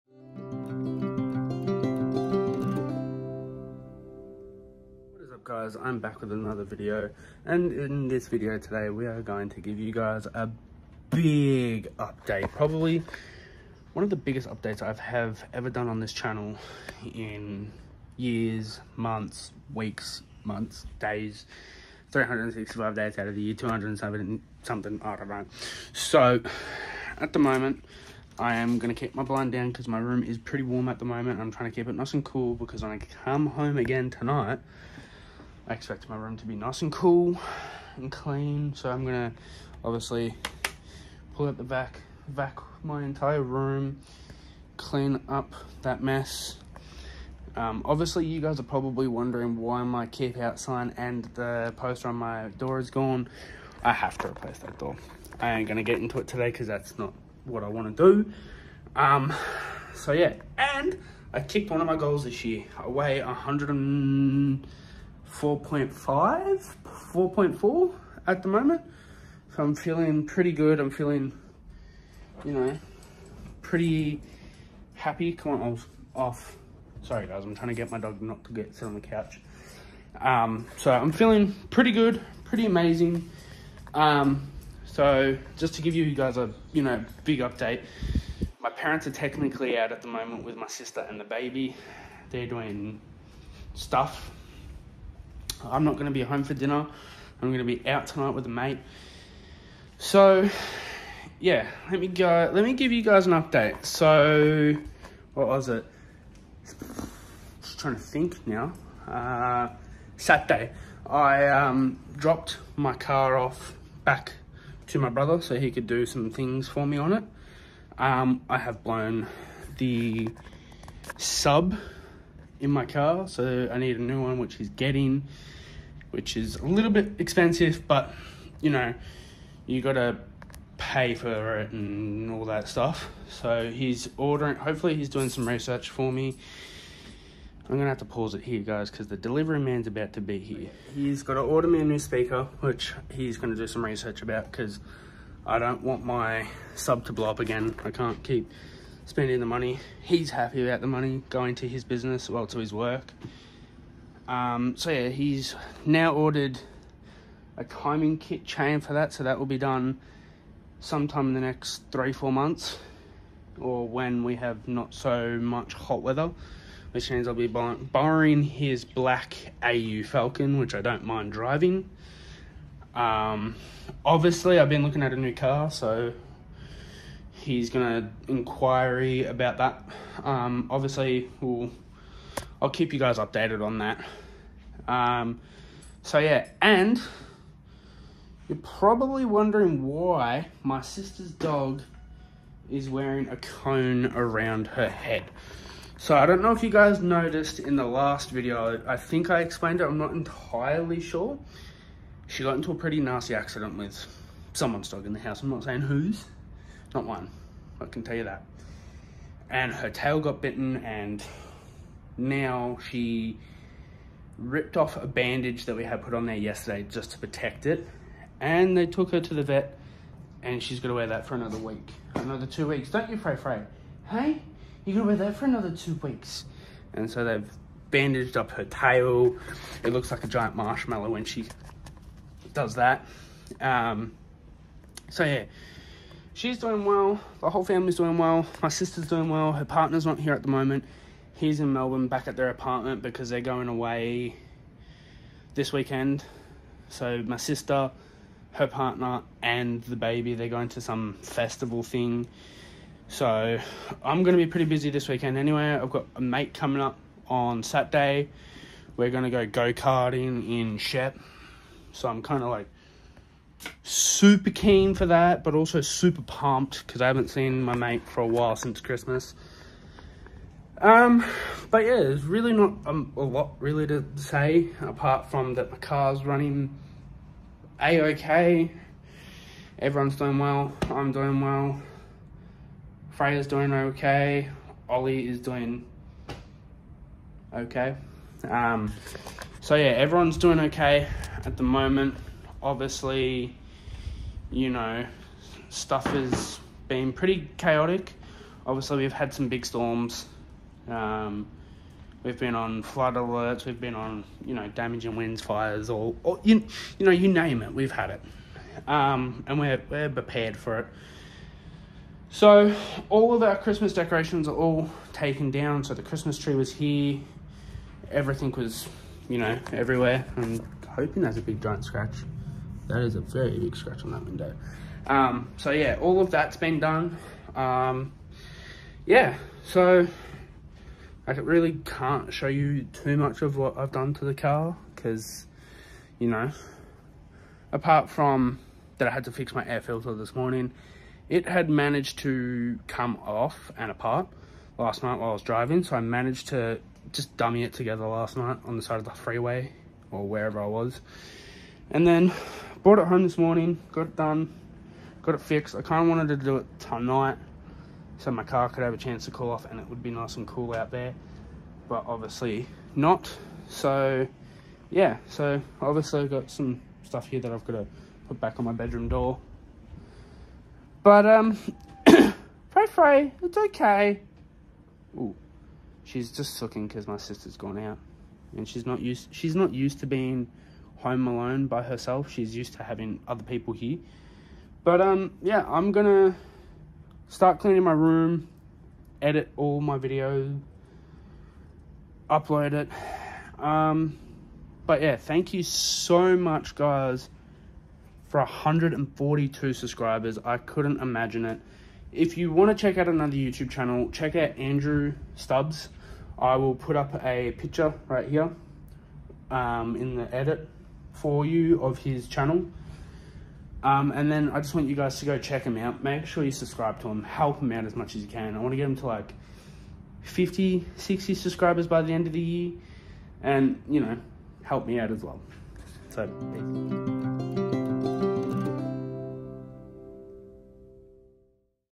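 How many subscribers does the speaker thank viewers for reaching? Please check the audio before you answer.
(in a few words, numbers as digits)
142.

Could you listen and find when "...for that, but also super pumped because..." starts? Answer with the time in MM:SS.
04:24.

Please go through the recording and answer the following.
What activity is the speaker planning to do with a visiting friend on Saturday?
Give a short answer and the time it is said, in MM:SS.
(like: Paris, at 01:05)
go karting, at 04:19.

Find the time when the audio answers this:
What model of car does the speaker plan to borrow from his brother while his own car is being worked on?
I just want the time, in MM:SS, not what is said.
02:49.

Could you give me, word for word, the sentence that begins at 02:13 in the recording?
So he's ordering, hopefully, he's doing some research for me.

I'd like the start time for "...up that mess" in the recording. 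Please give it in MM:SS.
00:45.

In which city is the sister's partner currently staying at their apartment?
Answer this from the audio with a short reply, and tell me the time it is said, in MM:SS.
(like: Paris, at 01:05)
Melbourne, at 04:01.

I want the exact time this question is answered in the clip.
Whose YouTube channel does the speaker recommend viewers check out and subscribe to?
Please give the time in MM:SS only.
06:44.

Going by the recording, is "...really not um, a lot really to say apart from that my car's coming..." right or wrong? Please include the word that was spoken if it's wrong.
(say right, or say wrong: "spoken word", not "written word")
wrong: "running", not "coming".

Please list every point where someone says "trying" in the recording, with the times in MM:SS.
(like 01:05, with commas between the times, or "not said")
00:31, 01:17, 01:47.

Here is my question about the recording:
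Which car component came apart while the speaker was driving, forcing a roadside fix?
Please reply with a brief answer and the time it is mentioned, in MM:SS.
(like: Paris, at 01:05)
air filter, at 05:39.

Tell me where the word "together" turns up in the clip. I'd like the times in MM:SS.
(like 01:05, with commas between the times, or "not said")
05:47.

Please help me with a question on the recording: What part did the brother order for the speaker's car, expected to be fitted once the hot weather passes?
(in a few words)
timing kit chain.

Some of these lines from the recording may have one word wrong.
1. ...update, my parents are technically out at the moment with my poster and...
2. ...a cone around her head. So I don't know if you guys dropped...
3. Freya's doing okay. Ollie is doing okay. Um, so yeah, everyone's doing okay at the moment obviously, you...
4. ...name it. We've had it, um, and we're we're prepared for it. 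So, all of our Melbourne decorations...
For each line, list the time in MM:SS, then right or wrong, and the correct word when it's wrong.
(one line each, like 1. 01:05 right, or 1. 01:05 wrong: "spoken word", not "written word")
1. 01:27 wrong: "sister", not "poster"
2. 03:13 wrong: "noticed", not "dropped"
3. 04:43 right
4. 05:07 wrong: "Christmas", not "Melbourne".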